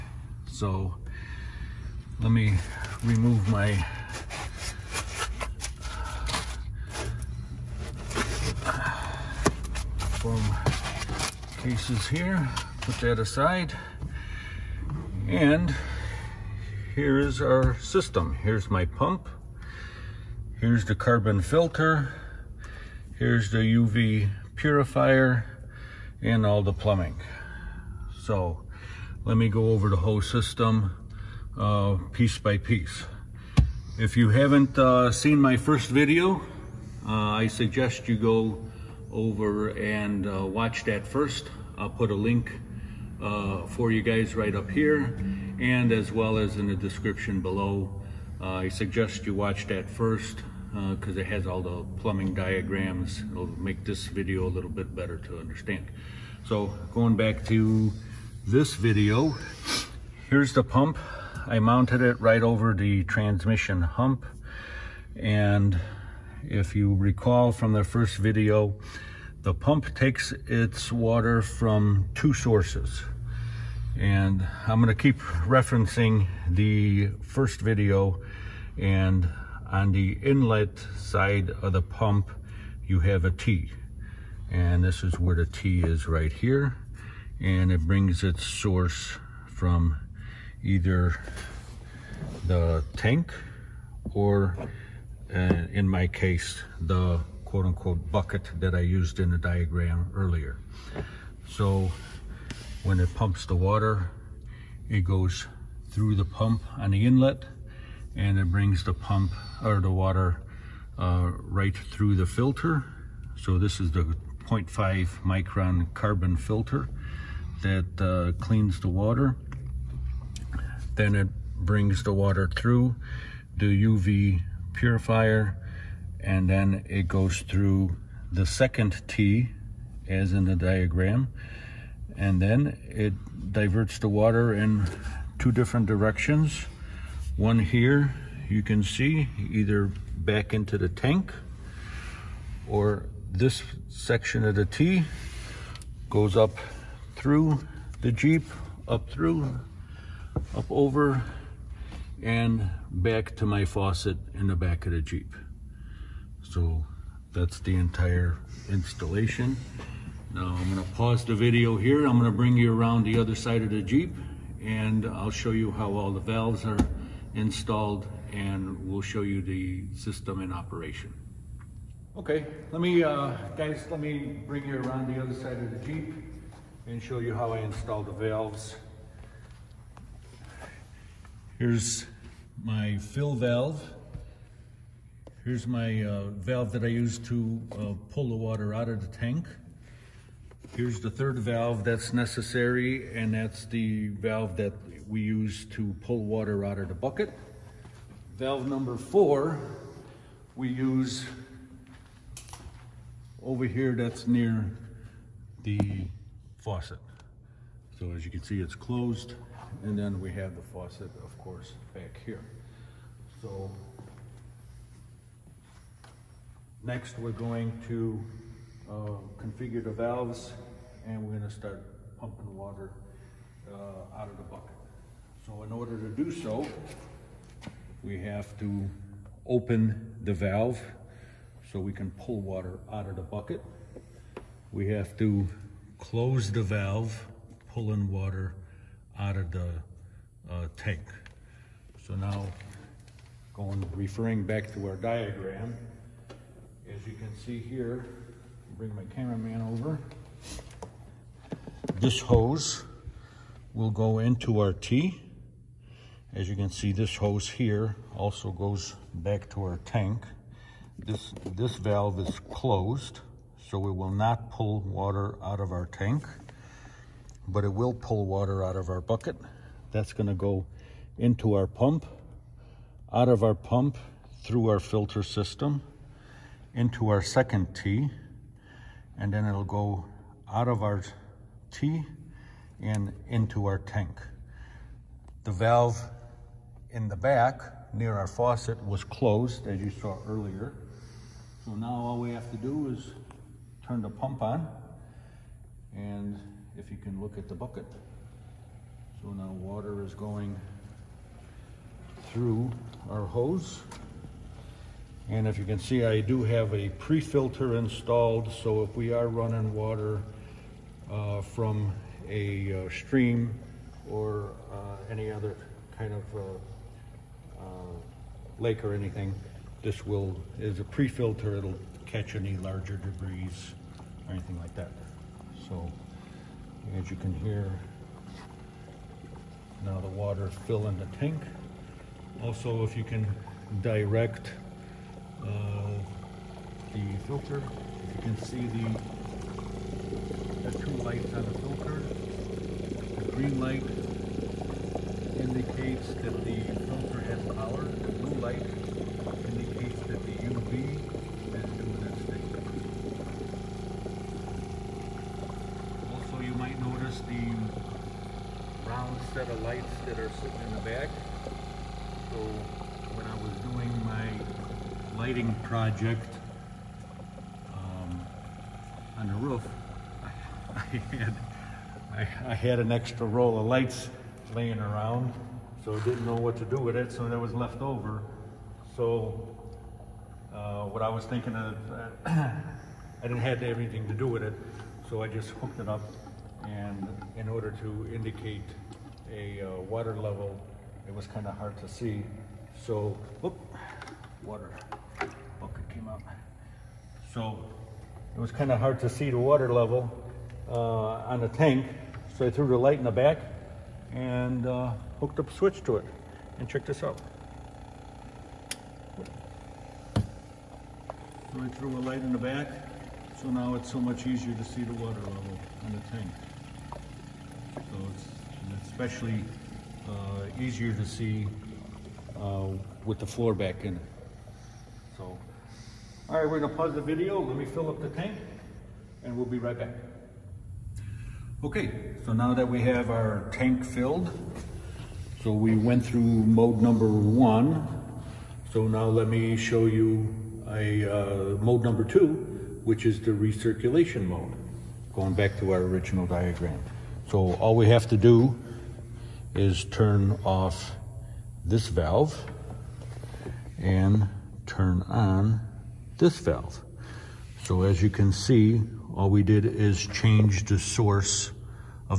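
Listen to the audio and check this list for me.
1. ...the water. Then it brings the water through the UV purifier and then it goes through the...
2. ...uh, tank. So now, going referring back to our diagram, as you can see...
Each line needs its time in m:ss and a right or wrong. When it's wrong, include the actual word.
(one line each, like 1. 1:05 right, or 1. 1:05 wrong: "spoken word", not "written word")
1. 1:58 right
2. 4:00 right.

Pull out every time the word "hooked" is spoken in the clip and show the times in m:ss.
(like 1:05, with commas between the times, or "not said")
6:25, 6:45.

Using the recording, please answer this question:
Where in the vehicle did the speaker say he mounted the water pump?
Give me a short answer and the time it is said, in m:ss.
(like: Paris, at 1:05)
Over the transmission hump, at 1:02.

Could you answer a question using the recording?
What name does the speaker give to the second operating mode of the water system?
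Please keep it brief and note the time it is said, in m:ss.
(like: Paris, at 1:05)
Recirculation mode, at 7:23.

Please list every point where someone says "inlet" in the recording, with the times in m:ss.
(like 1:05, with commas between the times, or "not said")
1:20, 1:47.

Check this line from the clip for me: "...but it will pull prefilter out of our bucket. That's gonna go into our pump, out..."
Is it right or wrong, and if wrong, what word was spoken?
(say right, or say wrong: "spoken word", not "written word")
wrong: "water", not "prefilter".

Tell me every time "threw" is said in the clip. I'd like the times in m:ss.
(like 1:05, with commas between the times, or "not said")
6:42, 6:51.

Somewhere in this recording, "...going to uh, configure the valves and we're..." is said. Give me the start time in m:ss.
3:37.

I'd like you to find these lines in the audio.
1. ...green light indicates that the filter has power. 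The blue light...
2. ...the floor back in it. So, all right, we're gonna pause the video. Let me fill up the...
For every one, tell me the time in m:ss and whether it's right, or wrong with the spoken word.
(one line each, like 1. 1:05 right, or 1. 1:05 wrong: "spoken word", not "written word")
1. 5:43 right
2. 7:03 right.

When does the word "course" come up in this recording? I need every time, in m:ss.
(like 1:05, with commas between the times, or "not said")
3:31.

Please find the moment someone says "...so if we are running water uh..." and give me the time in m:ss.
5:08.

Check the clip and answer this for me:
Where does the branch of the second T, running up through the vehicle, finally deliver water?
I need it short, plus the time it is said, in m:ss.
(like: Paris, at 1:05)
Faucet in the back, at 2:33.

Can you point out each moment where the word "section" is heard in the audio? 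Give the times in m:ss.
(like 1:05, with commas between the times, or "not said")
2:23.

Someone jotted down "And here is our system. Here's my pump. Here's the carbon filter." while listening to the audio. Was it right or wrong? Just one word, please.
right.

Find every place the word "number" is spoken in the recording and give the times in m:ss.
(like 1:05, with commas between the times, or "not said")
3:18, 7:16, 7:21.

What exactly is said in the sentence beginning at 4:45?
The valve in the back near our faucet was closed as you saw earlier.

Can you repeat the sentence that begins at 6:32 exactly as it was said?
So, whoop, water bucket came up.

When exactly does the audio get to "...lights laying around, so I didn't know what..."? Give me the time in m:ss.
6:13.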